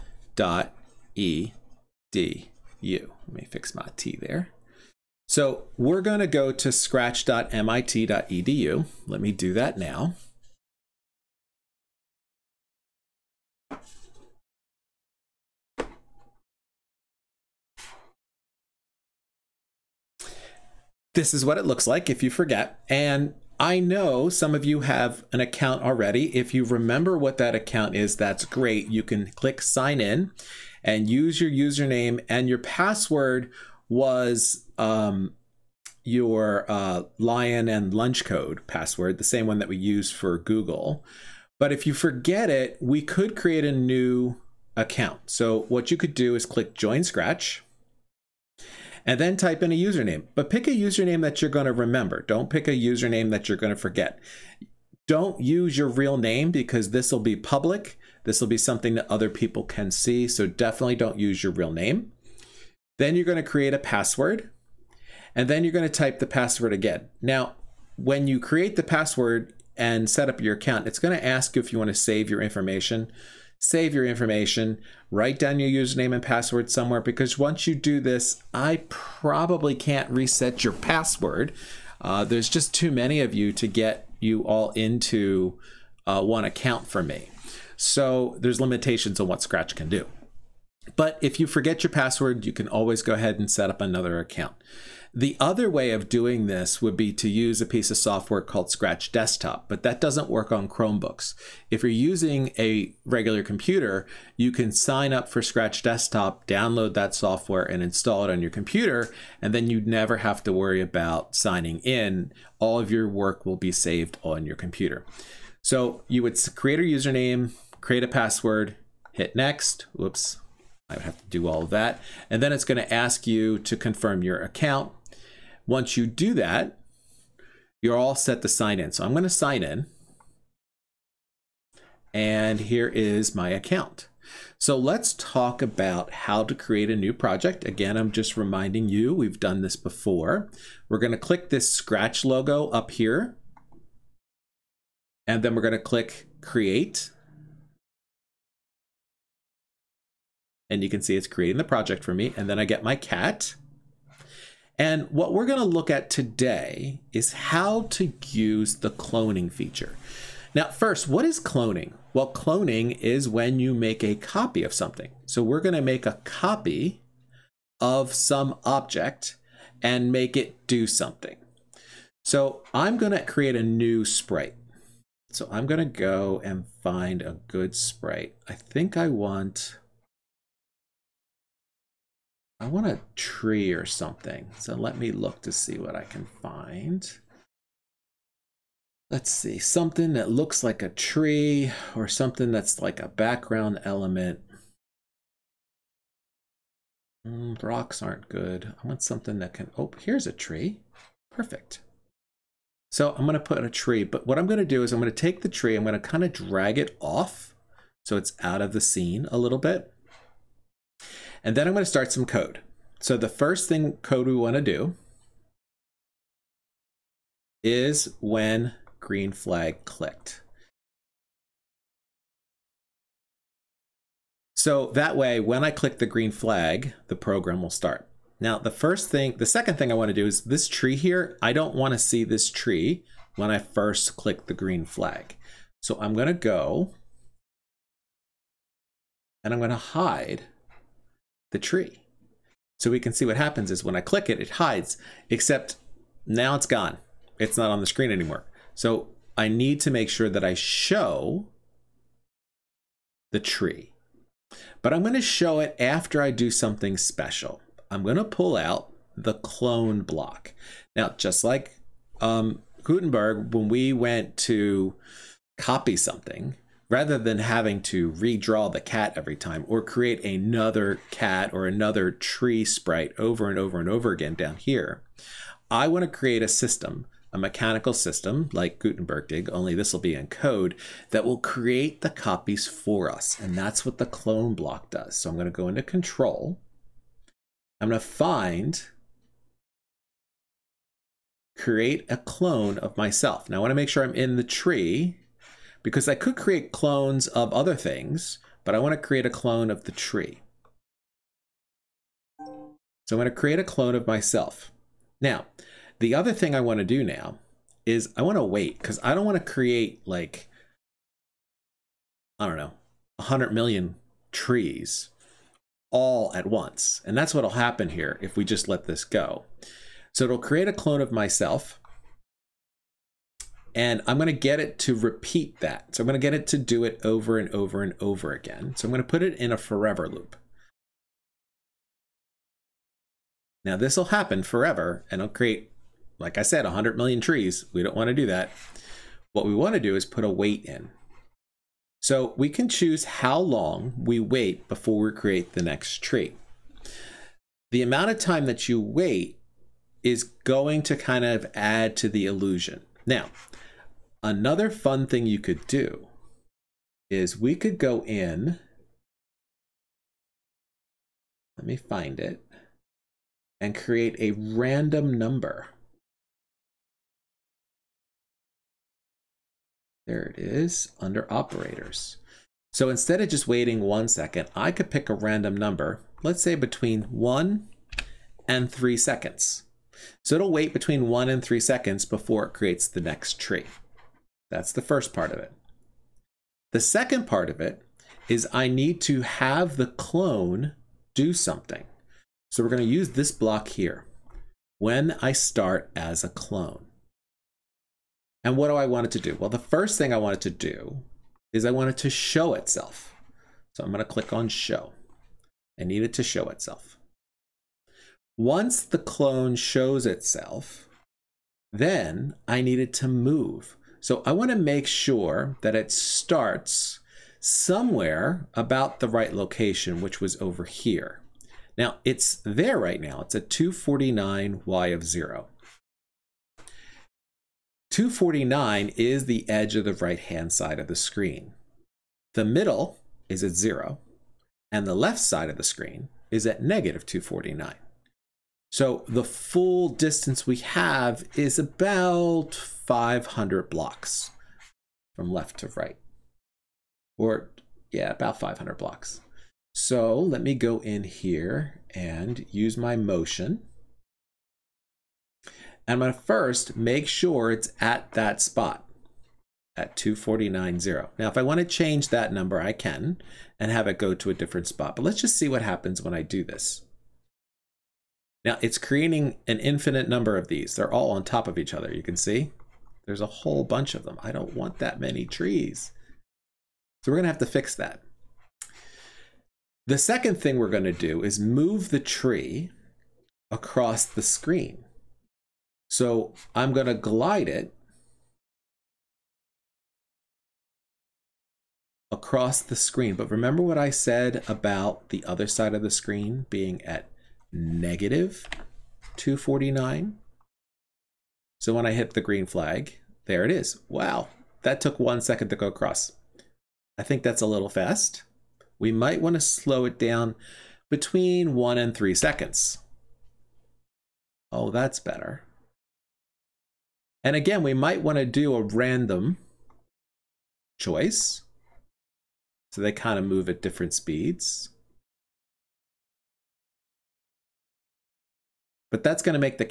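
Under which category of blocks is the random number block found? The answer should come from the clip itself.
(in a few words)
operators.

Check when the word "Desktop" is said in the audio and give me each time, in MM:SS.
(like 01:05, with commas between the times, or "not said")
01:39, 01:45.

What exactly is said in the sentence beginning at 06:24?
That's the first part of it.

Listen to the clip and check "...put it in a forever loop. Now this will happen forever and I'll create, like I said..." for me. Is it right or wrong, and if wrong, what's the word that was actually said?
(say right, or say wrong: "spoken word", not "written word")
right.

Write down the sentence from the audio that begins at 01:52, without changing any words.
All of your work will be saved on your computer.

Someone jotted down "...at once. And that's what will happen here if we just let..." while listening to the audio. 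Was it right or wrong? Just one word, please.
right.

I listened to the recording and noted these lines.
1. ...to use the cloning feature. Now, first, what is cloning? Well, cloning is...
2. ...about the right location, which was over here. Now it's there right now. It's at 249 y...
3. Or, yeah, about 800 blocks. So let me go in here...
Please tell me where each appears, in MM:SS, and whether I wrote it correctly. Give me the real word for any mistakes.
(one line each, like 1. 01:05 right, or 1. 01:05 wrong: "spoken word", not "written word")
1. 02:37 right
2. 06:58 right
3. 07:27 wrong: "500", not "800".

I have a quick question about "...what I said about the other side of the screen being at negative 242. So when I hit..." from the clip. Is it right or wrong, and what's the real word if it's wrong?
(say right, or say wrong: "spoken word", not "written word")
wrong: "249", not "242".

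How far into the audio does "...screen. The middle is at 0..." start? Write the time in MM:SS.
07:10.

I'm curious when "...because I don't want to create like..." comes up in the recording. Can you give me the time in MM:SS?
05:08.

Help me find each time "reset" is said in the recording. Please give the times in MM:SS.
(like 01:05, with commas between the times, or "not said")
01:20.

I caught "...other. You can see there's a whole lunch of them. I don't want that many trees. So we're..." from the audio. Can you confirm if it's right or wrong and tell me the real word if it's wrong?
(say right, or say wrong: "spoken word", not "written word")
wrong: "bunch", not "lunch".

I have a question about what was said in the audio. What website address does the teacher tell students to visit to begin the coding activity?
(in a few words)
scratch.mit.edu.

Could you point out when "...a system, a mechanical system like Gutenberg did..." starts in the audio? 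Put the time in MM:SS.
04:36.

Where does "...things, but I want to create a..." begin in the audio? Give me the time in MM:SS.
04:57.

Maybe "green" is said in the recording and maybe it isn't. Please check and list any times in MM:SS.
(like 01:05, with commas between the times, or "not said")
03:38, 03:46, 03:54, 08:22.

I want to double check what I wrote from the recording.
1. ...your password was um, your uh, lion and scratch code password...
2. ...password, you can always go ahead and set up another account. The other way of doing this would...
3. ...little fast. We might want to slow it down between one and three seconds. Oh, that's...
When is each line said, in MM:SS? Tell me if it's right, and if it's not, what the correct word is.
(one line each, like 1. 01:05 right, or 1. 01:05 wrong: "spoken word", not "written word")
1. 00:32 wrong: "lunch", not "scratch"
2. 01:31 right
3. 08:27 right.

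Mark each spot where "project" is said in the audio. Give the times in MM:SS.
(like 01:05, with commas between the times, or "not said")
02:17, 02:31.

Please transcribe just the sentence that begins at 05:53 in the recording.
Now, Another fun thing you could do is we could go in.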